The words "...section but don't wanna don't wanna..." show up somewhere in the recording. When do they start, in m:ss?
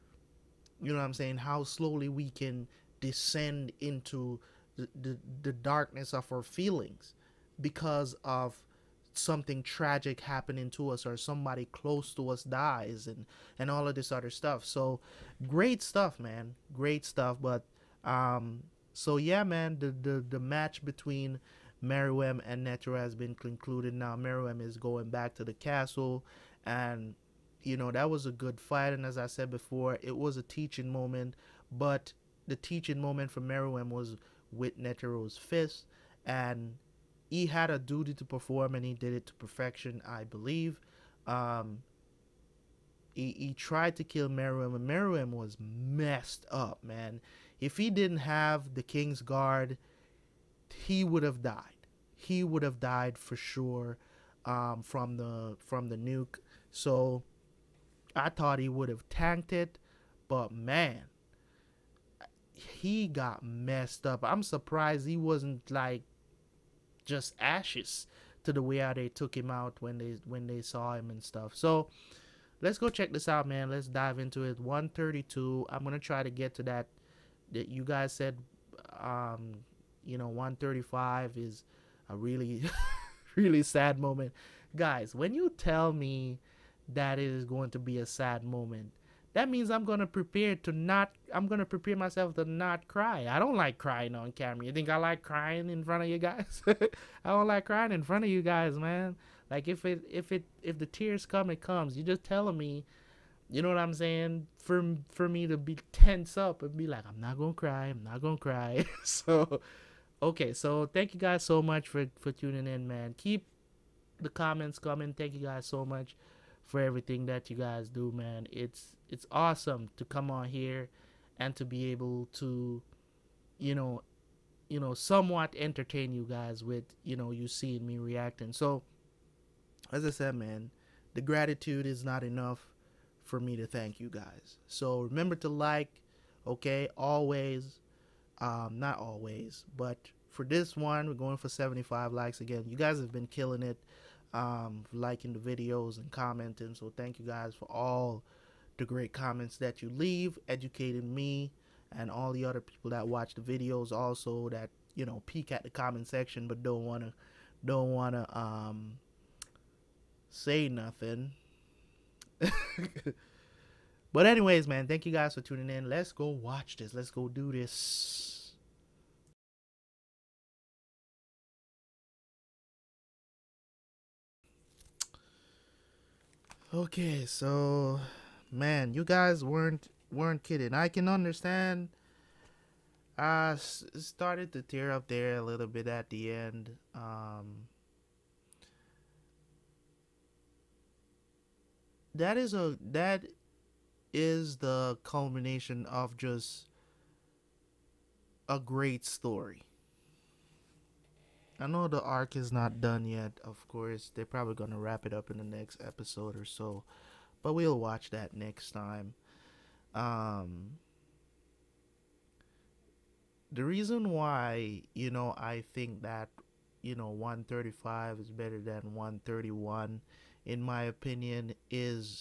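2:36.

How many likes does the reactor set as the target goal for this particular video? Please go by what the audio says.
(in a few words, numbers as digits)
75.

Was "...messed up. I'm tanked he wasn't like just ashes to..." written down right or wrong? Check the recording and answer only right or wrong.
wrong.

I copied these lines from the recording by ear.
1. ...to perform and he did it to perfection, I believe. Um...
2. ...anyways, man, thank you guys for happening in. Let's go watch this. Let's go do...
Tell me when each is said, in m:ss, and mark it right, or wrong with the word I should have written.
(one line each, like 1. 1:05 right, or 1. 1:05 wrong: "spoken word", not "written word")
1. 0:38 right
2. 2:44 wrong: "tuning", not "happening".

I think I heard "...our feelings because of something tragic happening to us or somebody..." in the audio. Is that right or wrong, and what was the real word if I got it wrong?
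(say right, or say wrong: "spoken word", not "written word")
right.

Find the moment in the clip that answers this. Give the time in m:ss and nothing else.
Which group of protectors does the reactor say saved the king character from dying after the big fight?
0:48.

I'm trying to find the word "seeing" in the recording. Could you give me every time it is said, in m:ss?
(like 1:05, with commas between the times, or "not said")
2:07.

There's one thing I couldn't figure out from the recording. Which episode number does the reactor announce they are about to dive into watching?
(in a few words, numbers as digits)
132.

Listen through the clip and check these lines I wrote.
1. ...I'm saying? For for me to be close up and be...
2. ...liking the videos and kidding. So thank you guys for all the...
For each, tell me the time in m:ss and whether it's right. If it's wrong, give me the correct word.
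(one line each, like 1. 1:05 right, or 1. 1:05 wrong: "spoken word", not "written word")
1. 1:43 wrong: "tense", not "close"
2. 2:24 wrong: "commenting", not "kidding".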